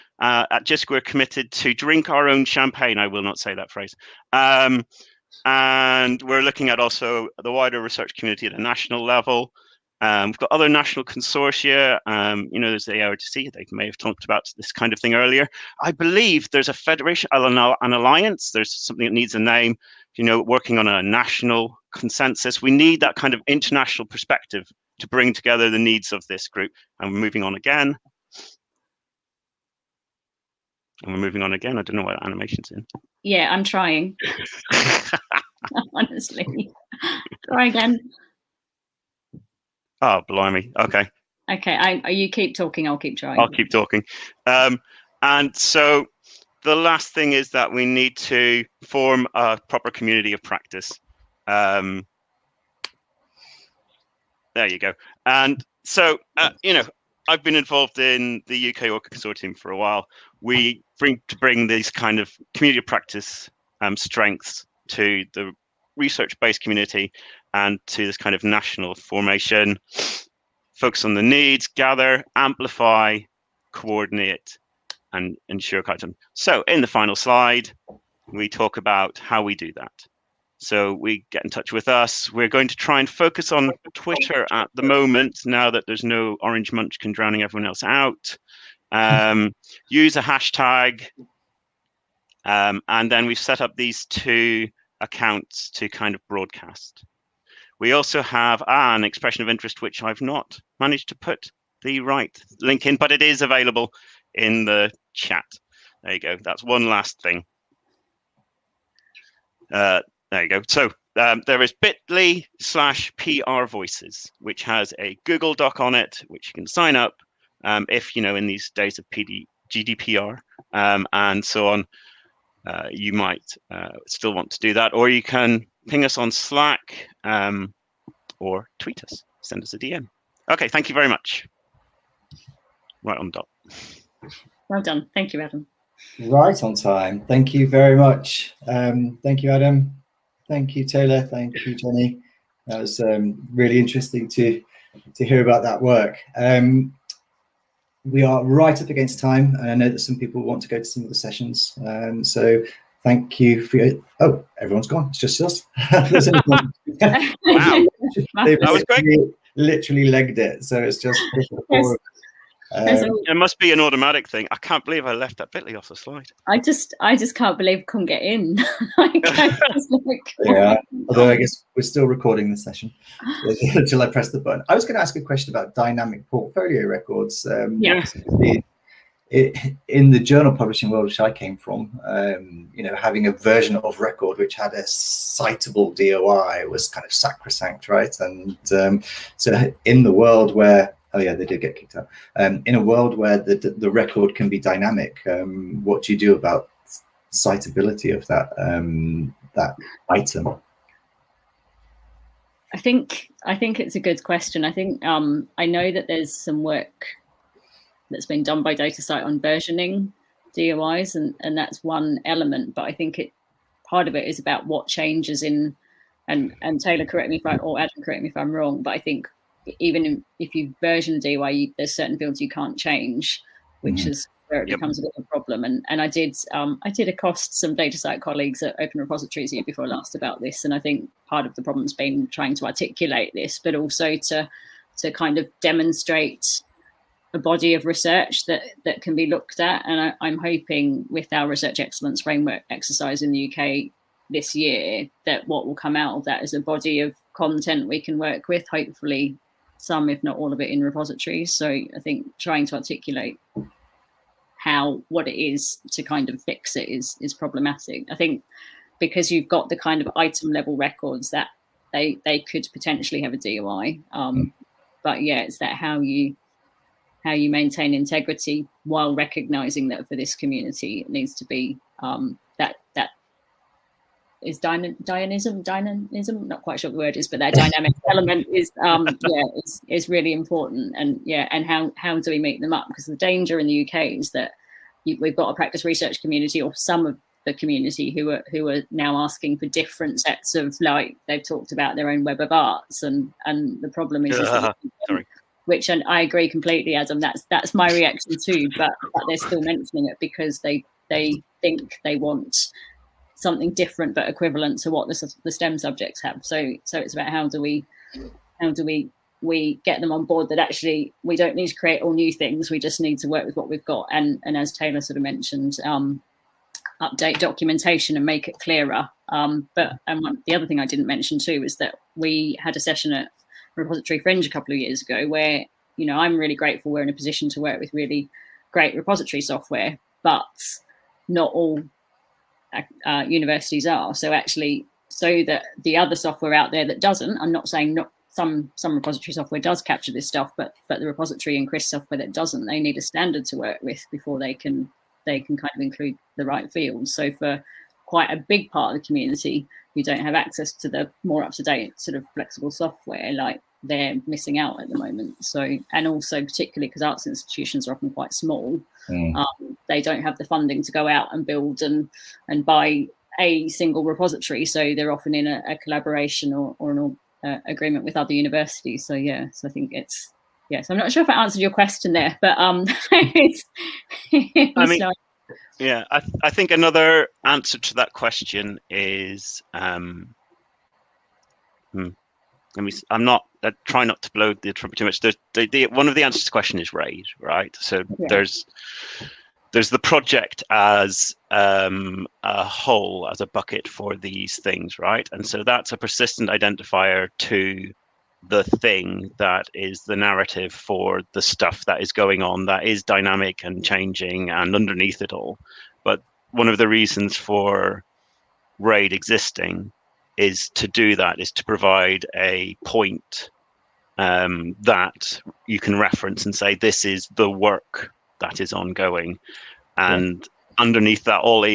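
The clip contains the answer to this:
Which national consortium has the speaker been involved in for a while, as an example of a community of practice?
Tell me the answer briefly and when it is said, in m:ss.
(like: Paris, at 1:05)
UK ORCID Consortium, at 0:58.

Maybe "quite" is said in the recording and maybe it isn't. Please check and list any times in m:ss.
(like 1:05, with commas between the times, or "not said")
4:36, 5:48, 5:58.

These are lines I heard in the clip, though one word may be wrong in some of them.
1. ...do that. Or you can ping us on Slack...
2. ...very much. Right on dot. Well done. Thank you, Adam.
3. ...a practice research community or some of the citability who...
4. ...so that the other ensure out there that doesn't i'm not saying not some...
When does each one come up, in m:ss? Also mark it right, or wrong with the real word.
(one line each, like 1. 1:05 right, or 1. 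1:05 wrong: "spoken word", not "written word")
1. 2:04 right
2. 2:10 right
3. 4:45 wrong: "community", not "citability"
4. 5:35 wrong: "software", not "ensure".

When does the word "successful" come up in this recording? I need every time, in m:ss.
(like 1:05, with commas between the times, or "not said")
not said.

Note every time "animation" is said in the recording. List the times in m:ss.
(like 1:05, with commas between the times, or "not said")
0:32.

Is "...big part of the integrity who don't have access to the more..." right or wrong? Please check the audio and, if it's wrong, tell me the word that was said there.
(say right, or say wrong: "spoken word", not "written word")
wrong: "community", not "integrity".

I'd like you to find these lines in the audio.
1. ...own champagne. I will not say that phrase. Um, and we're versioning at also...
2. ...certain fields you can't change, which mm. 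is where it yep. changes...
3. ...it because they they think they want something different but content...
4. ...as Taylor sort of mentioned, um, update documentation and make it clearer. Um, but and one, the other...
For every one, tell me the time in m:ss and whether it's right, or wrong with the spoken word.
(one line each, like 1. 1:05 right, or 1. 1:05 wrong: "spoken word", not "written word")
1. 0:02 wrong: "looking", not "versioning"
2. 3:41 wrong: "becomes", not "changes"
3. 5:00 wrong: "equivalent", not "content"
4. 5:14 right.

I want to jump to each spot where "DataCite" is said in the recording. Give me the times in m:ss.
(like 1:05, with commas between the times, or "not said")
3:28, 3:47.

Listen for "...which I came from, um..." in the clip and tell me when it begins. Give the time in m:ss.
3:01.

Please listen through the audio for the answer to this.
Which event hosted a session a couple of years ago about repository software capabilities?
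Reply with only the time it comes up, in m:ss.
5:23.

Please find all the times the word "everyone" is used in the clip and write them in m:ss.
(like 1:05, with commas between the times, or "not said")
1:27, 2:34.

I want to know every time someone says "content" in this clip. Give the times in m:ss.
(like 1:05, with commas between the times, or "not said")
1:15, 4:07.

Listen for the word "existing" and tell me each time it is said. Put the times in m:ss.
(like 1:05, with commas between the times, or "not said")
6:49.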